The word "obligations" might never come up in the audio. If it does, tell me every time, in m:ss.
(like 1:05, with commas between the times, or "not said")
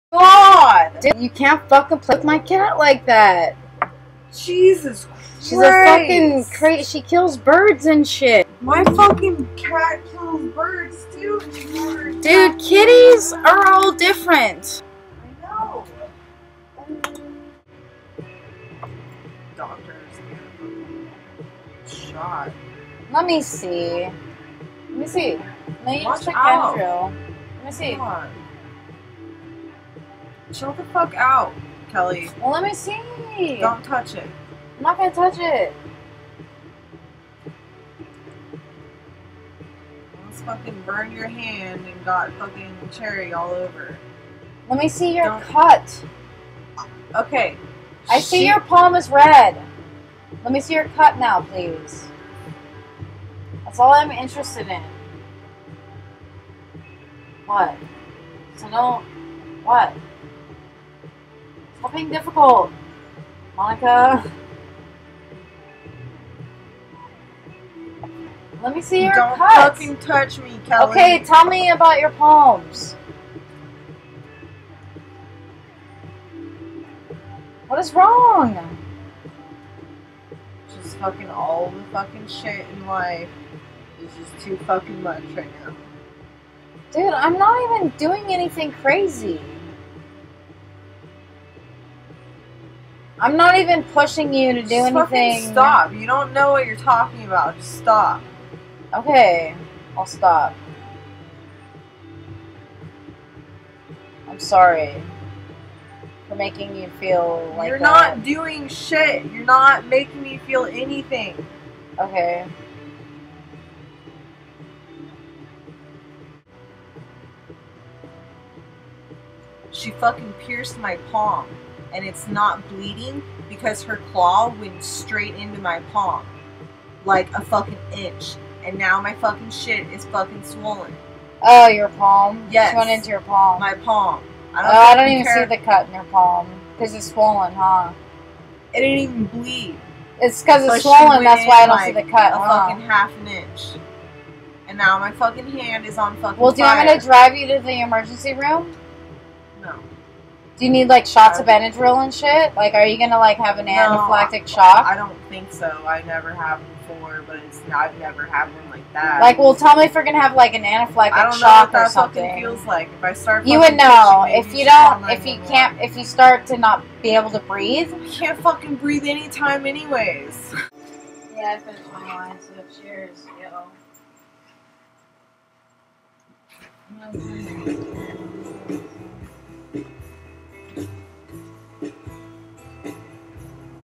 not said.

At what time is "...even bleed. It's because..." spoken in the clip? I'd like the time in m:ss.
2:18.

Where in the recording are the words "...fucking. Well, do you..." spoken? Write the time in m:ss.
2:26.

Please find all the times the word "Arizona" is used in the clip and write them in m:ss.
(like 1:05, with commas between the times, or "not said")
not said.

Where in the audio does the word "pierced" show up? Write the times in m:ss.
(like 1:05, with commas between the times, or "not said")
2:00.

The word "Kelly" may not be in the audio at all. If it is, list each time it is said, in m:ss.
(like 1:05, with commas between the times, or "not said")
0:31, 1:10.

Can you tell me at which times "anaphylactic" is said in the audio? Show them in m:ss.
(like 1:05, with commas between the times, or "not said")
2:33, 2:40.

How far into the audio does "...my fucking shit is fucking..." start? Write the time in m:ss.
2:09.